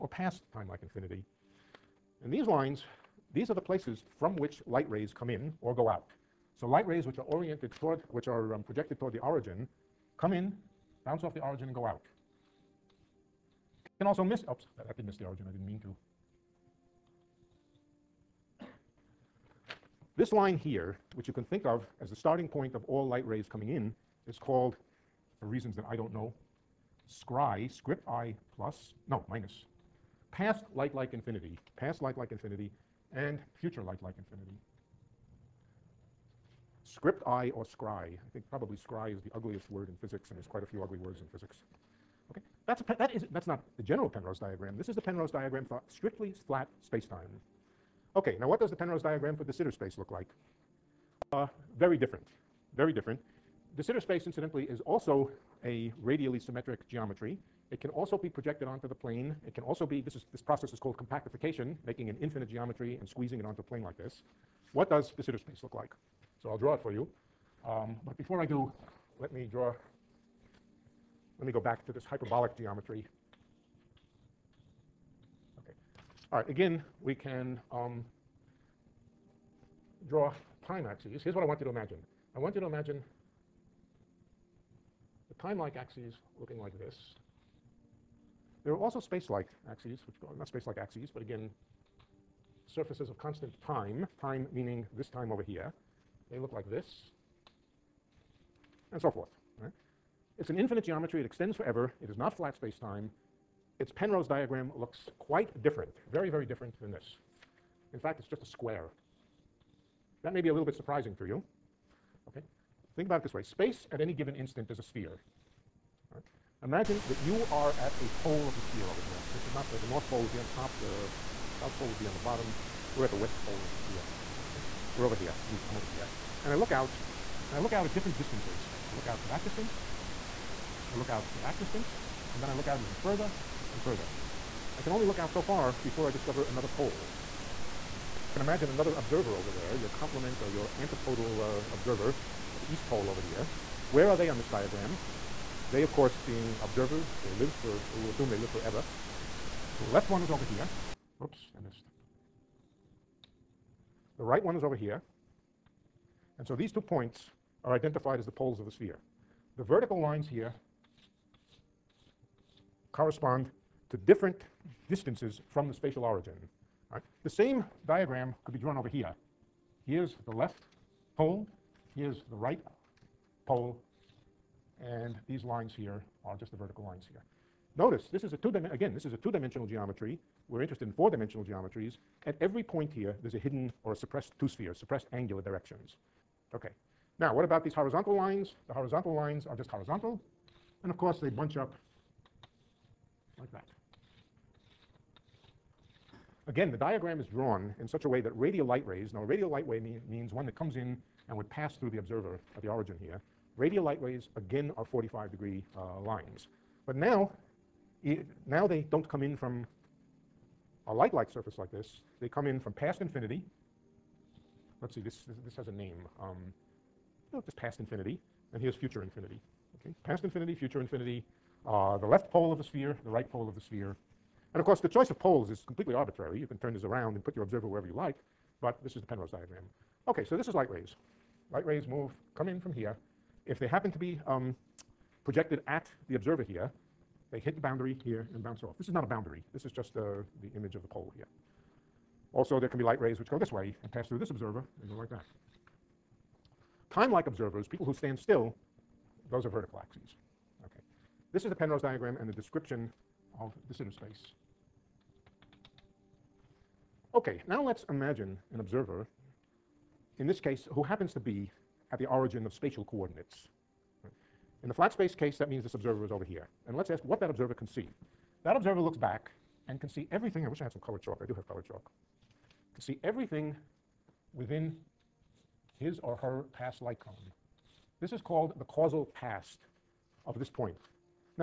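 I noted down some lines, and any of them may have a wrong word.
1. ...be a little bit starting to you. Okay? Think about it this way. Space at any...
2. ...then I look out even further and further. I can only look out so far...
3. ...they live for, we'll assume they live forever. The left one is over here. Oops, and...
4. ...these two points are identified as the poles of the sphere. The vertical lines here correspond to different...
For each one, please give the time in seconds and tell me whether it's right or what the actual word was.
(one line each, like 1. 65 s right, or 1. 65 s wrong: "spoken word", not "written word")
1. 110 s wrong: "surprising", not "starting"
2. 132 s right
3. 147 s right
4. 156 s right.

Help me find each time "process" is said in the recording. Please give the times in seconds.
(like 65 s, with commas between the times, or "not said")
60 s.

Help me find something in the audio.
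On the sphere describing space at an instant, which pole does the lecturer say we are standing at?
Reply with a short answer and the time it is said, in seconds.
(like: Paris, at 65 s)
West Pole, at 123 s.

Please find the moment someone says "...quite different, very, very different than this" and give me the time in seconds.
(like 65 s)
105 s.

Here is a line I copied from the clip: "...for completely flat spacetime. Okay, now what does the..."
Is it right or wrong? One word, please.
wrong.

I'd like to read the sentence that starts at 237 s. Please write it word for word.
They hit the boundary here and bounce off.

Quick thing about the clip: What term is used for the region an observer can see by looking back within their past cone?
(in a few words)
Causal past.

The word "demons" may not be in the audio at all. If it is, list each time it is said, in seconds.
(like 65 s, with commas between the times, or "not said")
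not said.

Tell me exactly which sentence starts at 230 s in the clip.
Okay, so this is light rays.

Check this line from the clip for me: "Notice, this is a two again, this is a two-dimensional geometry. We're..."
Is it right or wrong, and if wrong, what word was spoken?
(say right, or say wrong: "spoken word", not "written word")
right.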